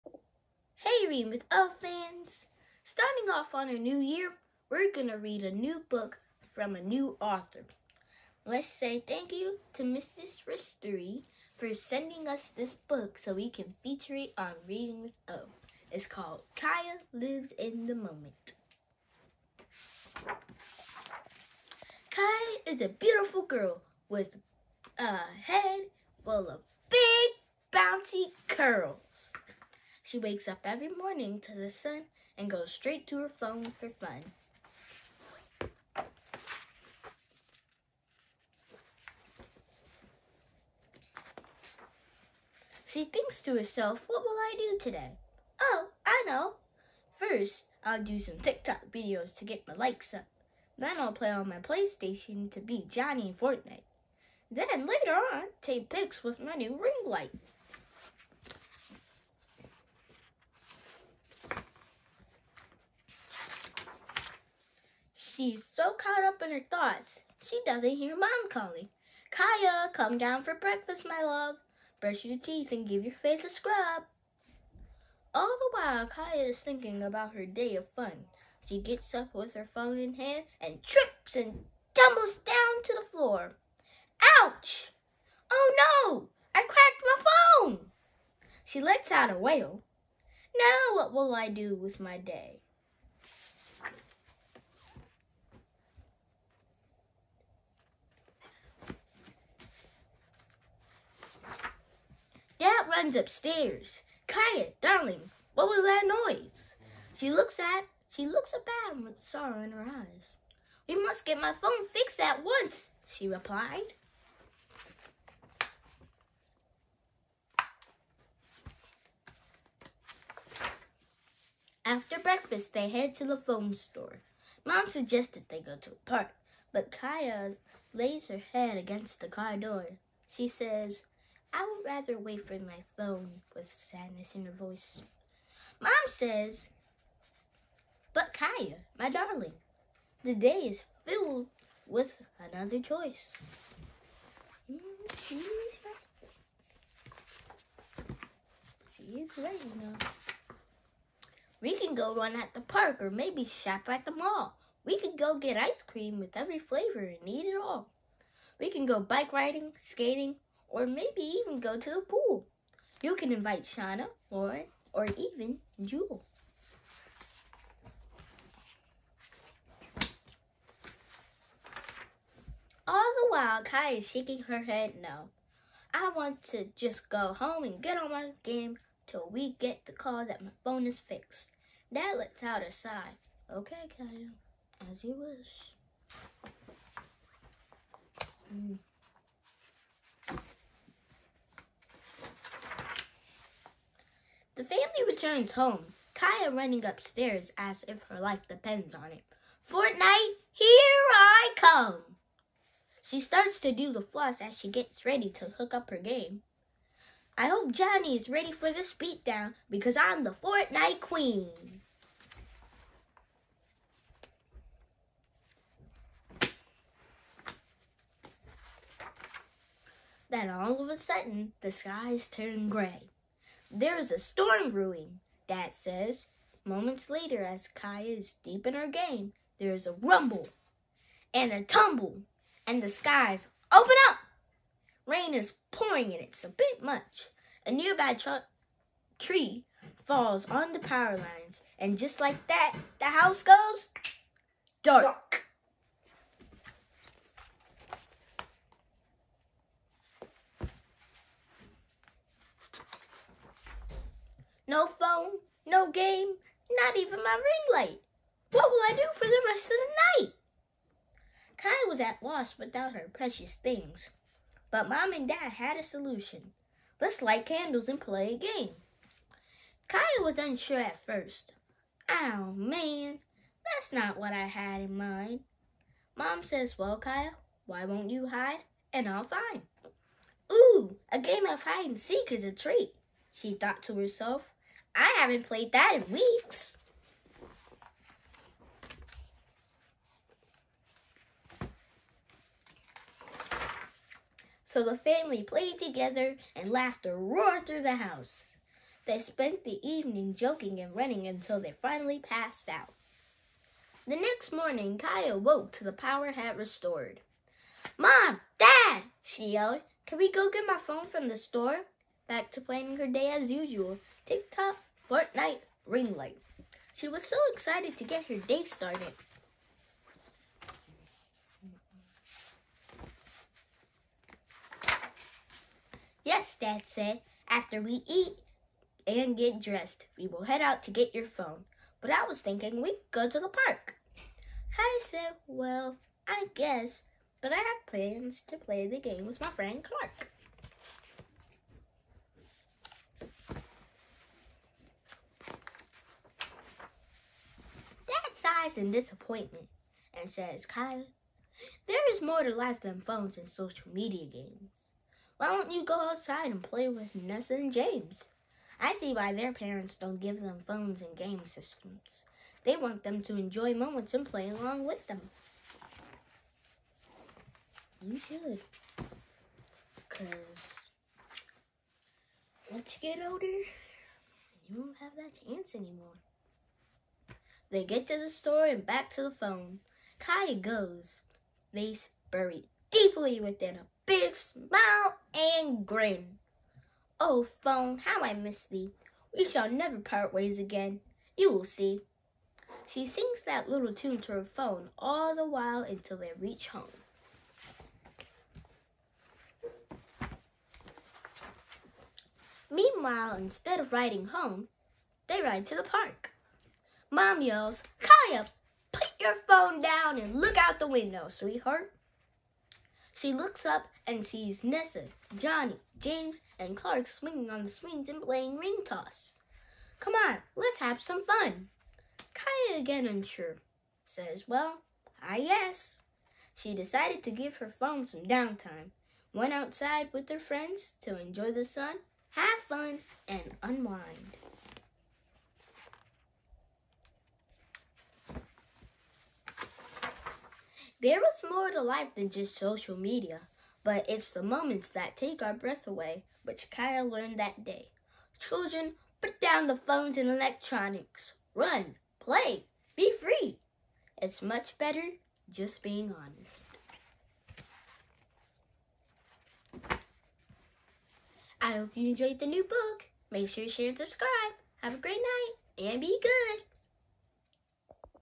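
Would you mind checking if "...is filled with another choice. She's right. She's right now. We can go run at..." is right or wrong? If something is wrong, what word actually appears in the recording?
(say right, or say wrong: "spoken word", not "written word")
right.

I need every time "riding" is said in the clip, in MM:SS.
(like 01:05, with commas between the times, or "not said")
02:39, 06:43.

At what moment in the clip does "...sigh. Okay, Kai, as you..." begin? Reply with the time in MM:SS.
03:02.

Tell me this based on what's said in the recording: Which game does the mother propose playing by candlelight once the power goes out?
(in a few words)
Hide and seek.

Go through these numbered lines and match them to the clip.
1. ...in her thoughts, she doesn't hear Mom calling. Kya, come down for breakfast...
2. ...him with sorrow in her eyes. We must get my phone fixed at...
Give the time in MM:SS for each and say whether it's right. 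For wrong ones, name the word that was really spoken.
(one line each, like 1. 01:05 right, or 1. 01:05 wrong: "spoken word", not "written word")
1. 01:06 right
2. 01:48 right.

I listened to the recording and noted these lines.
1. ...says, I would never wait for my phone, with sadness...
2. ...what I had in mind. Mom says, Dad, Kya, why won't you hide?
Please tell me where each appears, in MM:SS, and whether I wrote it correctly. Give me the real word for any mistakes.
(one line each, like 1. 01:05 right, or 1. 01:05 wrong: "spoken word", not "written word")
1. 02:10 wrong: "rather", not "never"
2. 04:34 wrong: "Well", not "Dad".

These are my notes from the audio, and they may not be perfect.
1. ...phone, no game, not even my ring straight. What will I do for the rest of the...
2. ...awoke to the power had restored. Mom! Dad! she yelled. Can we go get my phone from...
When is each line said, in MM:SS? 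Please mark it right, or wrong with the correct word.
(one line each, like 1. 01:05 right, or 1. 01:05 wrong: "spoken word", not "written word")
1. 04:14 wrong: "light", not "straight"
2. 05:05 right.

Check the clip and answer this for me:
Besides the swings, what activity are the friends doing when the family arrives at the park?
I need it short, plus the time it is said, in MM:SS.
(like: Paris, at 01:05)
Ring toss, at 06:58.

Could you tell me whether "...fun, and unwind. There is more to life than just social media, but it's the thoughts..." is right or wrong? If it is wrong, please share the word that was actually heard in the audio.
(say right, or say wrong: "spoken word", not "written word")
wrong: "moments", not "thoughts".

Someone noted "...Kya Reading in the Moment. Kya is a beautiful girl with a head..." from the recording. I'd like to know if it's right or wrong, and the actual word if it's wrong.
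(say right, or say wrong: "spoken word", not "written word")
wrong: "Lives", not "Reading".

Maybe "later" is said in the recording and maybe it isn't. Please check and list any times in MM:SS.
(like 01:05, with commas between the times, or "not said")
00:54, 03:47.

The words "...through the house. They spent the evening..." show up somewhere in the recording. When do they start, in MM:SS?
04:57.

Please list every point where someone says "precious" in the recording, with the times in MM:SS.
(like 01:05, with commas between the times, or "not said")
04:23.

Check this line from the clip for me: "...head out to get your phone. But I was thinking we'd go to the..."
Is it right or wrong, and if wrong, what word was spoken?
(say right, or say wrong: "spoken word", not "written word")
right.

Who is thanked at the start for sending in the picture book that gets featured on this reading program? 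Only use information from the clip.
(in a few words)
Mrs. Ristery.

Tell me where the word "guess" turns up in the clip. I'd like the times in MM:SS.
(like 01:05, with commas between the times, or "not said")
05:36, 07:05.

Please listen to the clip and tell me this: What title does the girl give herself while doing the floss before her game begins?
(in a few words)
Fortnite queen.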